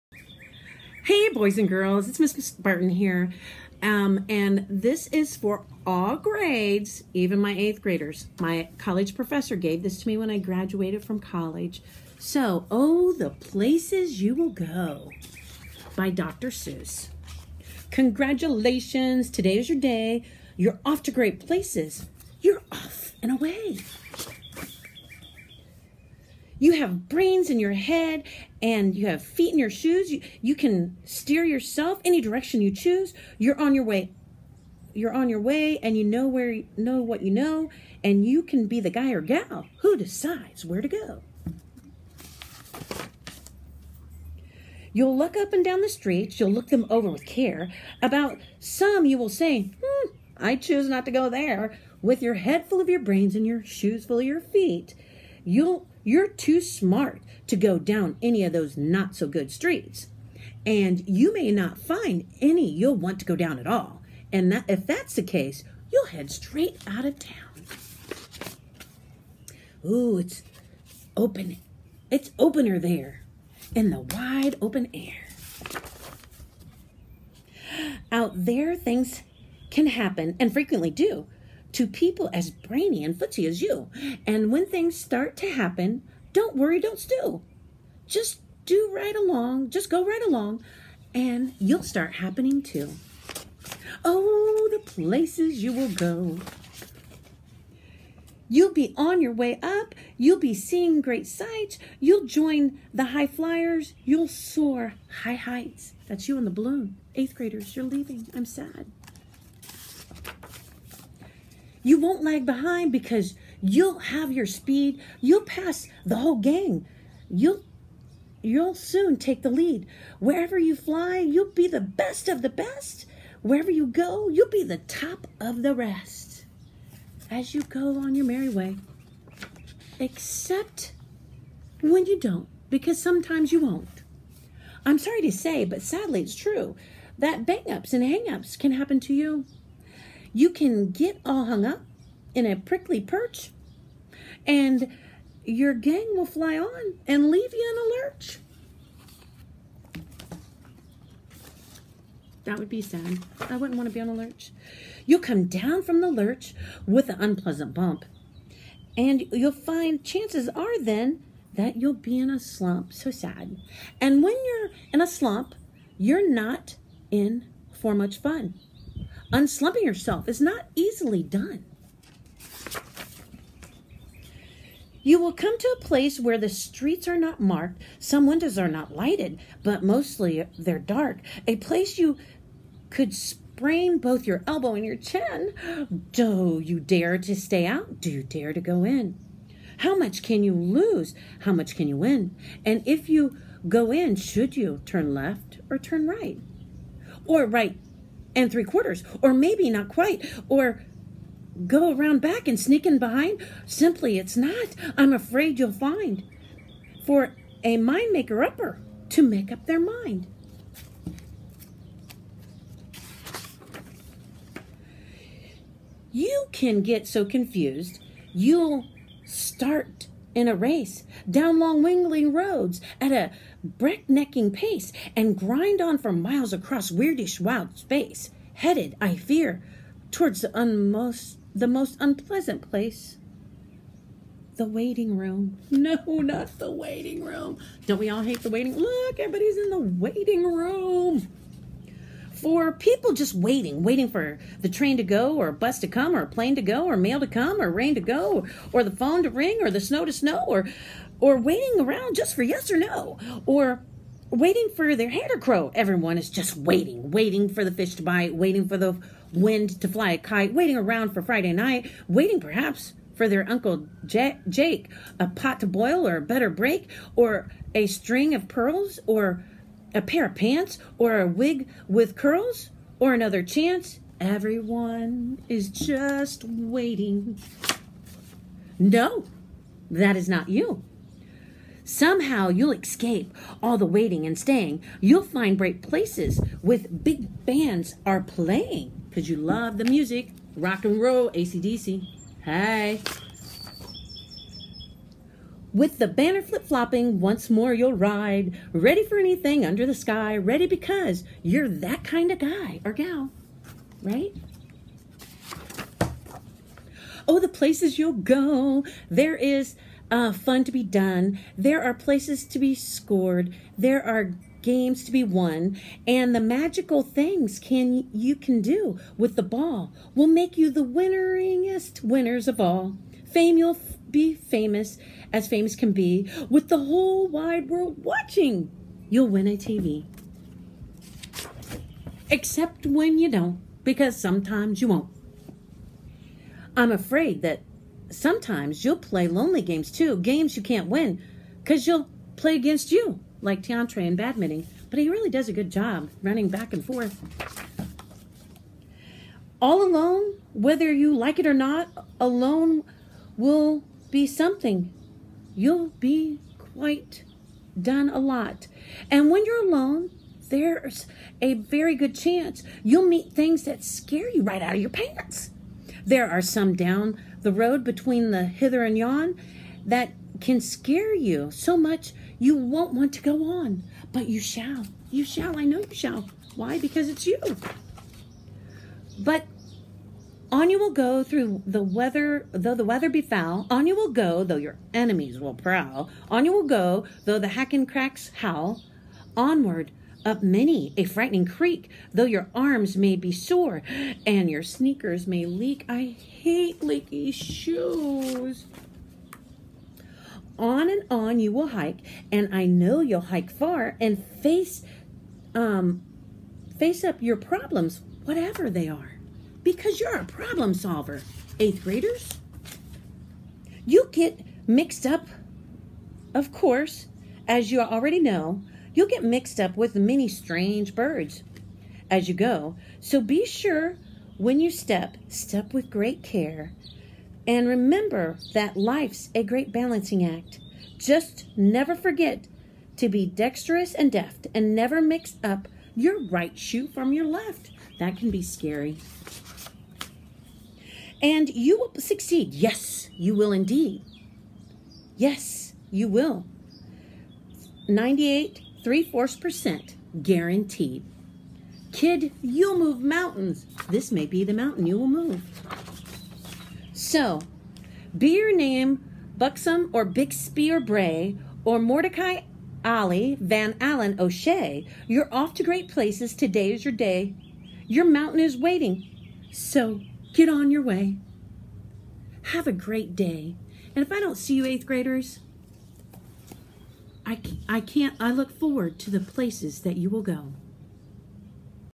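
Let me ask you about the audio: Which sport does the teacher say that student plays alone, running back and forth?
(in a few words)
Badminton.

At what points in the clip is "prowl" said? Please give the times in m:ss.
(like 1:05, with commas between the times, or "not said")
6:25.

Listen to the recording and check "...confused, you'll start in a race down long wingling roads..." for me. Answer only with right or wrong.
right.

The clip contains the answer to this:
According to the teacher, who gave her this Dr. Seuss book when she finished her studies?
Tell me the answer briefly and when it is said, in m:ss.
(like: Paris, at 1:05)
My college professor, at 0:08.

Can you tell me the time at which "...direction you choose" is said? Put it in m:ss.
0:32.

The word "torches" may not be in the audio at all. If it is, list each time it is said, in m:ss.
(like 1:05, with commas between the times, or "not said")
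not said.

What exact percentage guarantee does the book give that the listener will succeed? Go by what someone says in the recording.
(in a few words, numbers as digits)
98 3/4 percent.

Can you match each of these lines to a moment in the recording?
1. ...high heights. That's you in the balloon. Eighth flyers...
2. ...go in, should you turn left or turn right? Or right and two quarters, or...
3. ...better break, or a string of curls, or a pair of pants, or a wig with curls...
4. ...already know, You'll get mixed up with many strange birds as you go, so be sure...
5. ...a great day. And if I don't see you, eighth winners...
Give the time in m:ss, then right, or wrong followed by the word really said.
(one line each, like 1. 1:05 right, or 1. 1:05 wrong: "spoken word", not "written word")
1. 1:45 wrong: "graders", not "flyers"
2. 3:13 wrong: "three", not "two"
3. 4:26 wrong: "pearls", not "curls"
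4. 6:57 right
5. 7:52 wrong: "graders", not "winners".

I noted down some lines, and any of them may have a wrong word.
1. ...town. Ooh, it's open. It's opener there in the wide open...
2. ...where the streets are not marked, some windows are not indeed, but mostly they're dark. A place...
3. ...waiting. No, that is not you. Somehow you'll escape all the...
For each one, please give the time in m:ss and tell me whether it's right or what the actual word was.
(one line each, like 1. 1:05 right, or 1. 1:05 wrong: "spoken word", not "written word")
1. 1:07 right
2. 2:56 wrong: "lighted", not "indeed"
3. 4:36 right.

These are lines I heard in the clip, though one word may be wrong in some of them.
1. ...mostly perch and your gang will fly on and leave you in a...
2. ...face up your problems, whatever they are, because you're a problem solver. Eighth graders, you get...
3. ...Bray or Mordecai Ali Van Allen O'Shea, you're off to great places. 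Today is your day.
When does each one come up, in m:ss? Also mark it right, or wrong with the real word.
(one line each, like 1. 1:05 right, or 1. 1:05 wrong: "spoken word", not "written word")
1. 2:22 wrong: "prickly", not "mostly"
2. 6:46 right
3. 7:40 right.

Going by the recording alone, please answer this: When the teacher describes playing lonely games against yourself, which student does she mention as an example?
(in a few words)
Tiantre.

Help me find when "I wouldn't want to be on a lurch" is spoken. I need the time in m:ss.
2:33.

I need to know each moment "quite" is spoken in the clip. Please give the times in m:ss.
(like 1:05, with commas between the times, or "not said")
3:19, 5:56.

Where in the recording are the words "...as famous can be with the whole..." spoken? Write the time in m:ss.
5:25.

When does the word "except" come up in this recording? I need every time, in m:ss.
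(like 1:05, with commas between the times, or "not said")
2:09, 5:32.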